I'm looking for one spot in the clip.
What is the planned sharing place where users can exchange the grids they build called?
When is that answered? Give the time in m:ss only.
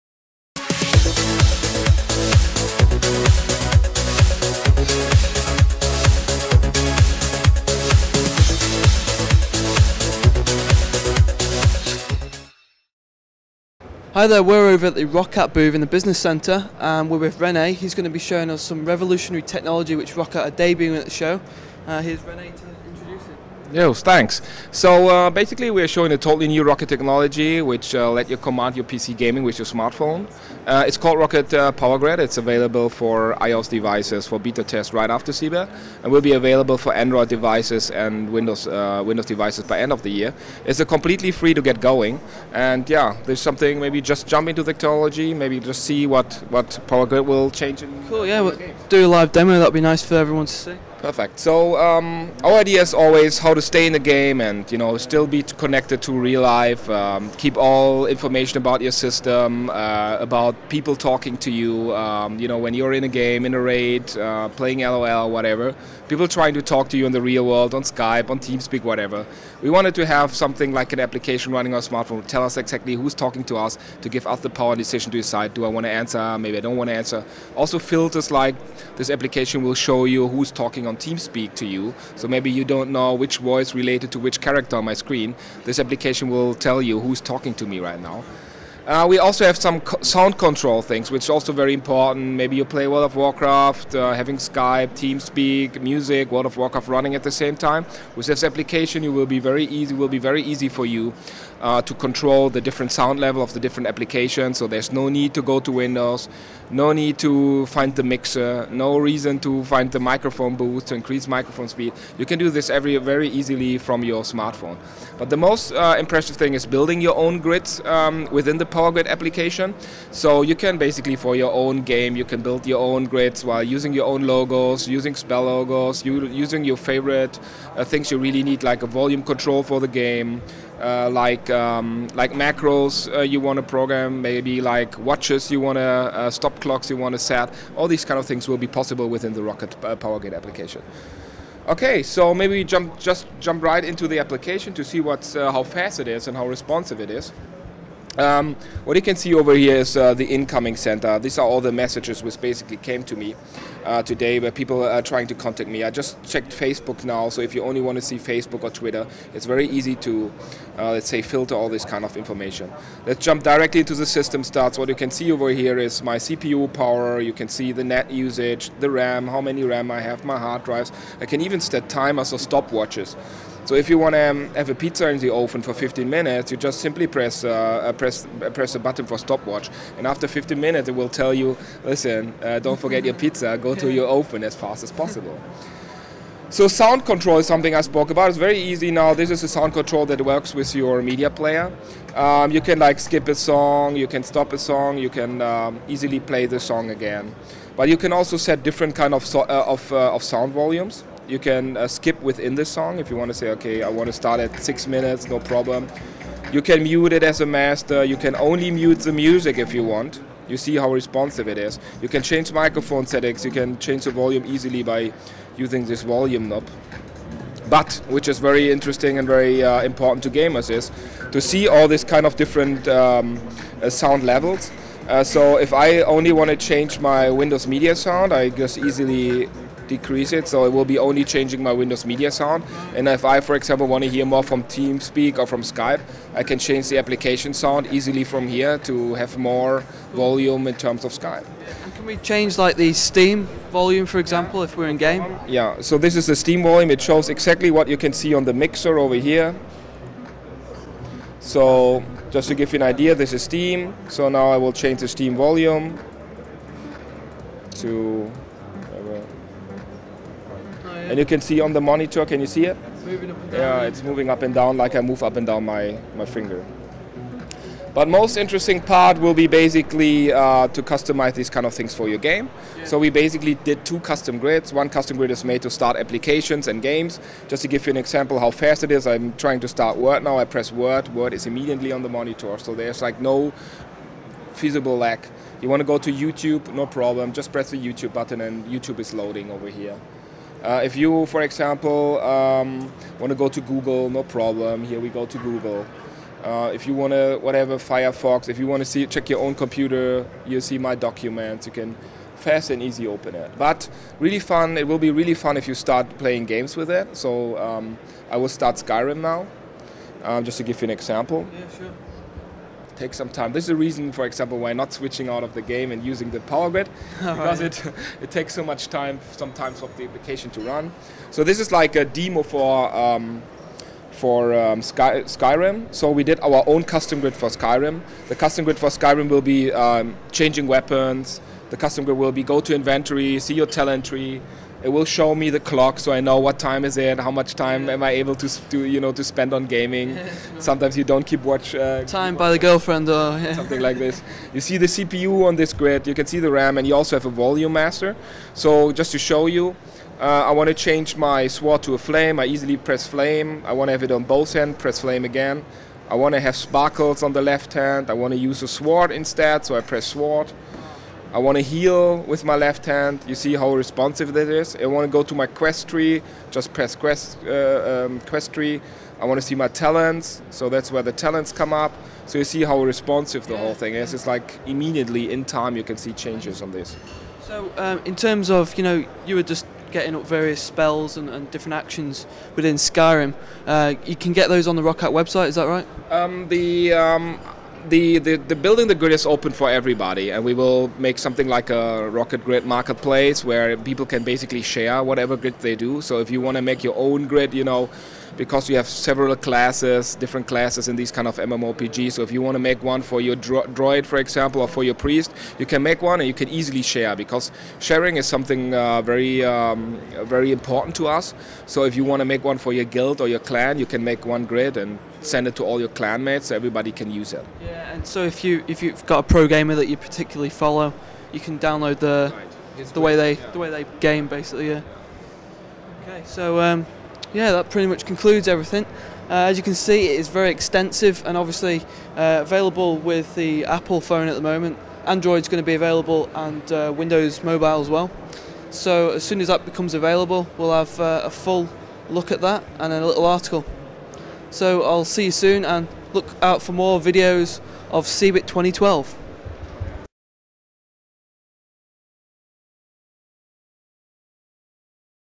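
6:32.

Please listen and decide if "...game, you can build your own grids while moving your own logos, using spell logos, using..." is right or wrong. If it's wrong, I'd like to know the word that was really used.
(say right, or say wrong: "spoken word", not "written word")
wrong: "using", not "moving".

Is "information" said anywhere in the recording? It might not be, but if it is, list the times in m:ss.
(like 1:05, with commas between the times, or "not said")
0:58, 2:42.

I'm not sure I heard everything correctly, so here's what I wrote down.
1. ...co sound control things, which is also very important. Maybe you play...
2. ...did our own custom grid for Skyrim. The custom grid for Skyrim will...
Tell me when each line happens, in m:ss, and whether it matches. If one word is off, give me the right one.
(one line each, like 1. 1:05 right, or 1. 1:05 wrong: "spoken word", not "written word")
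1. 1:29 right
2. 5:26 right.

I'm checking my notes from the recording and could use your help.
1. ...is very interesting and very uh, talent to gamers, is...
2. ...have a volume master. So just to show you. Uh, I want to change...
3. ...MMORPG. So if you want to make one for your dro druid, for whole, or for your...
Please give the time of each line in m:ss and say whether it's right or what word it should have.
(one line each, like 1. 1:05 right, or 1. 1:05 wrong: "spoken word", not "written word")
1. 3:38 wrong: "important", not "talent"
2. 5:47 right
3. 6:41 wrong: "example", not "whole".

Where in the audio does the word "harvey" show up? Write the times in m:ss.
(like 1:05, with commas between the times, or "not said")
not said.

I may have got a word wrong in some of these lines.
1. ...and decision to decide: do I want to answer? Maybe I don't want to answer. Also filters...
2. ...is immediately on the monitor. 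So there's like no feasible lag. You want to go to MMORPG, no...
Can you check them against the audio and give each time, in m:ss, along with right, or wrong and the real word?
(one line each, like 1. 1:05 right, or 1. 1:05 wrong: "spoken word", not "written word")
1. 1:14 right
2. 4:41 wrong: "YouTube", not "MMORPG".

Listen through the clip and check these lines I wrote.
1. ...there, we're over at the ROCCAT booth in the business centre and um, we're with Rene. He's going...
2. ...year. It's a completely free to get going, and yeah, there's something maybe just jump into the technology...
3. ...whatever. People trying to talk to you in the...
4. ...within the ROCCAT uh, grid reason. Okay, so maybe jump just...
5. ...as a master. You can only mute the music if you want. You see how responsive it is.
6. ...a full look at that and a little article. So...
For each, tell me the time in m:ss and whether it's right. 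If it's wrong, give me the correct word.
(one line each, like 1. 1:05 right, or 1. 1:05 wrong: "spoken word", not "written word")
1. 0:14 right
2. 0:40 right
3. 1:05 right
4. 2:19 wrong: "application", not "reason"
5. 3:27 right
6. 7:21 right.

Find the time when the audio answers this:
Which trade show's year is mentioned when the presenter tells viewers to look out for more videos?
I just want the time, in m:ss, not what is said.
7:28.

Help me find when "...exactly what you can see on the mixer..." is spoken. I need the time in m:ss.
4:07.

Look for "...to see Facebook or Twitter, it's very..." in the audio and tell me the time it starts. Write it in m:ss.
2:37.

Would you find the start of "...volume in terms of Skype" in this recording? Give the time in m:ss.
4:00.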